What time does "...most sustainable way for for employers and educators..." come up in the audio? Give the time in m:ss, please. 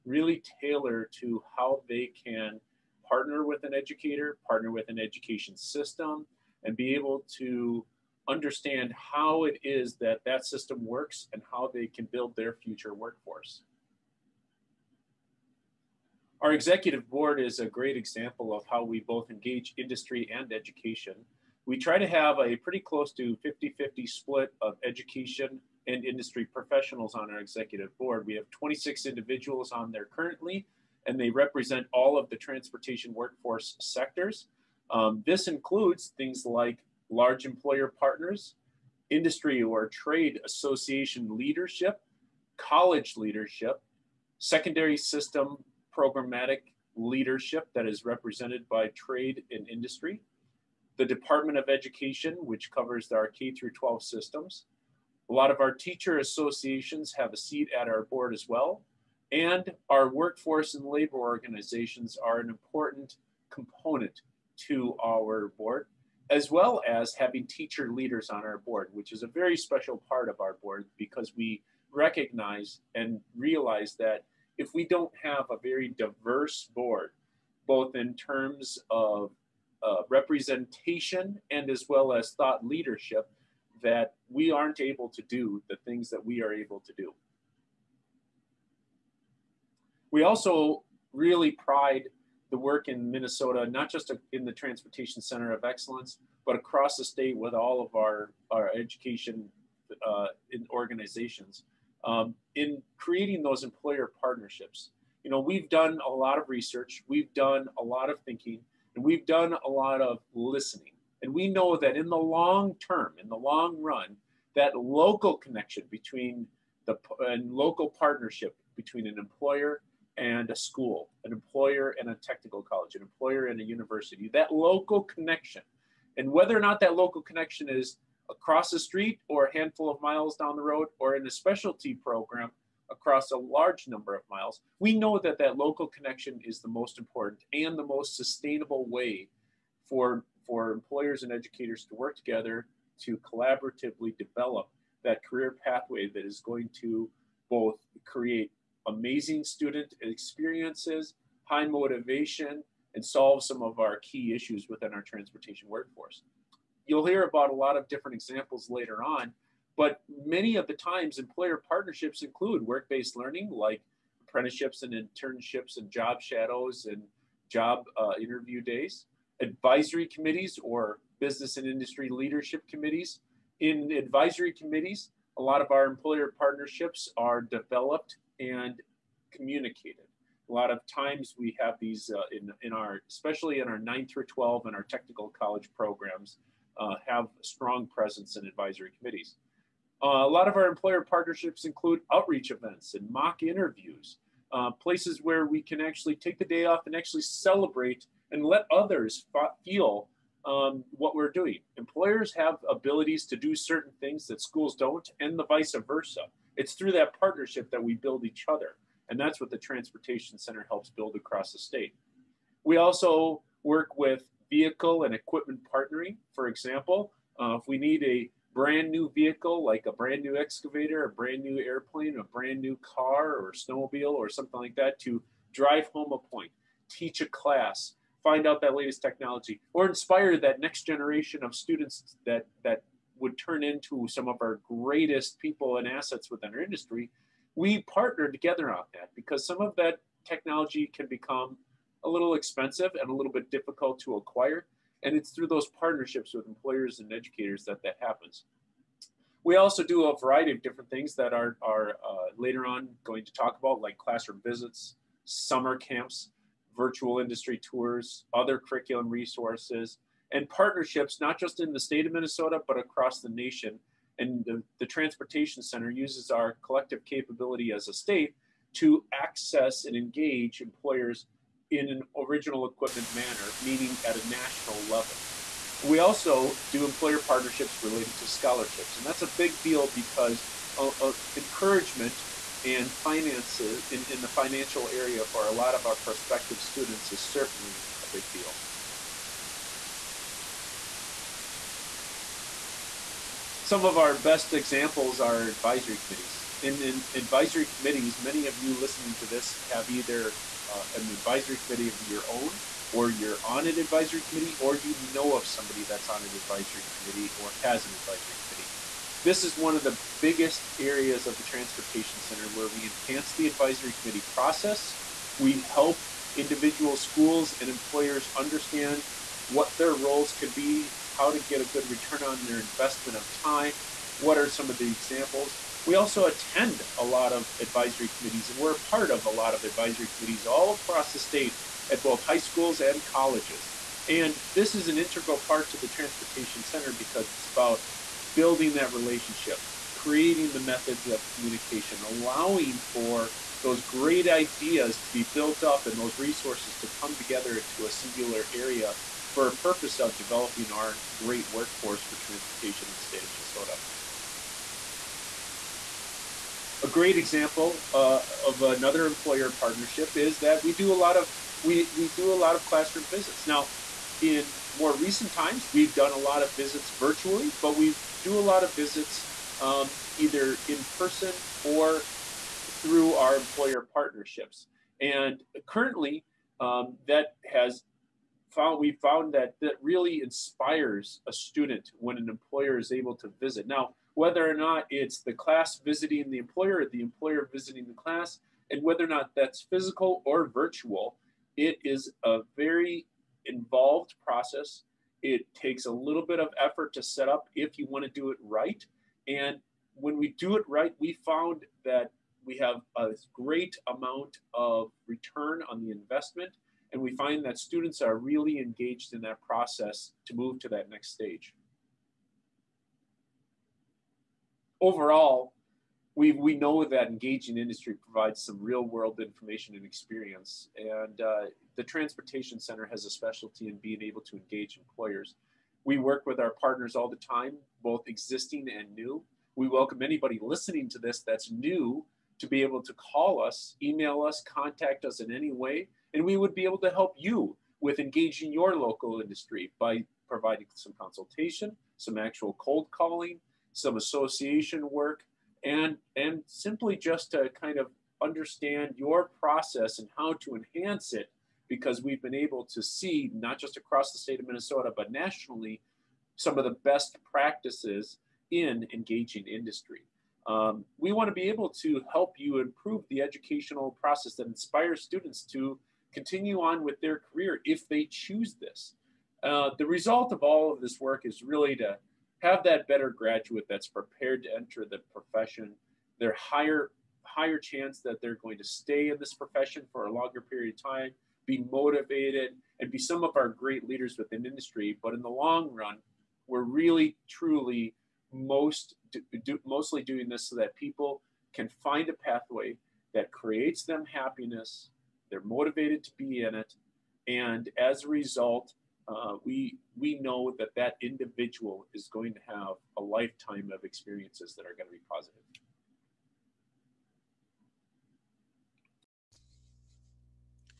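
2:17.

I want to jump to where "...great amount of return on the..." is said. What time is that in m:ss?
6:43.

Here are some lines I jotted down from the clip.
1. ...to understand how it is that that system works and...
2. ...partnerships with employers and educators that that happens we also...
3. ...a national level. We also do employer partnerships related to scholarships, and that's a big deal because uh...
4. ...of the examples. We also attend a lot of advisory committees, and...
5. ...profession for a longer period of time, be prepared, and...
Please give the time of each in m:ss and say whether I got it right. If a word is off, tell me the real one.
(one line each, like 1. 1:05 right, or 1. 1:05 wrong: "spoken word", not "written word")
1. 0:07 right
2. 4:05 right
3. 4:34 right
4. 5:24 right
5. 7:59 wrong: "motivated", not "prepared".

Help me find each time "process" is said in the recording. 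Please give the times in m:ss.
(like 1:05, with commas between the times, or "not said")
5:14, 6:34, 6:49, 7:29, 7:44.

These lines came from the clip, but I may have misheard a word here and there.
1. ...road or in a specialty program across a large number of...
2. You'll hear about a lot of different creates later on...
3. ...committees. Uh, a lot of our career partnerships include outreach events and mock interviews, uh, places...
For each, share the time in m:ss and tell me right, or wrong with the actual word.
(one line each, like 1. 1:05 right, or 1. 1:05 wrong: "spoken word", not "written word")
1. 2:10 right
2. 2:36 wrong: "examples", not "creates"
3. 3:08 wrong: "employer", not "career".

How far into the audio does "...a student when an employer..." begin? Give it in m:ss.
6:21.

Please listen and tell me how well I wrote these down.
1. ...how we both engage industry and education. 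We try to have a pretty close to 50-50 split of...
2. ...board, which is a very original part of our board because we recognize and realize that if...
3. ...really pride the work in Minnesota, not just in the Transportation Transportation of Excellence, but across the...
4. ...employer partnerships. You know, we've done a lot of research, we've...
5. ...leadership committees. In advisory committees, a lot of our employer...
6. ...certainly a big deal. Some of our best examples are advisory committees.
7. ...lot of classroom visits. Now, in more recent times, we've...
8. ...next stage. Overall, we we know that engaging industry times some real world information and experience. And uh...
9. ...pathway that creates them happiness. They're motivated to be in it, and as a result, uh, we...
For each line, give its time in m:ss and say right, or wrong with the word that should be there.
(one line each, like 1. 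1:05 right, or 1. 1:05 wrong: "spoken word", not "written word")
1. 0:18 right
2. 1:08 wrong: "special", not "original"
3. 1:31 wrong: "Center", not "Transportation"
4. 1:43 right
5. 2:52 right
6. 4:47 right
7. 6:02 right
8. 6:50 wrong: "provides", not "times"
9. 8:12 right.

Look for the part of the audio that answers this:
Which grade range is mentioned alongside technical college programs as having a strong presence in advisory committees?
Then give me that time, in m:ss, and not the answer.
3:03.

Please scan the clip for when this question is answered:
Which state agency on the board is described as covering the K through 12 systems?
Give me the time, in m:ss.
0:51.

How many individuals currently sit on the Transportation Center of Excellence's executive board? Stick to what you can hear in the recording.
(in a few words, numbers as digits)
26.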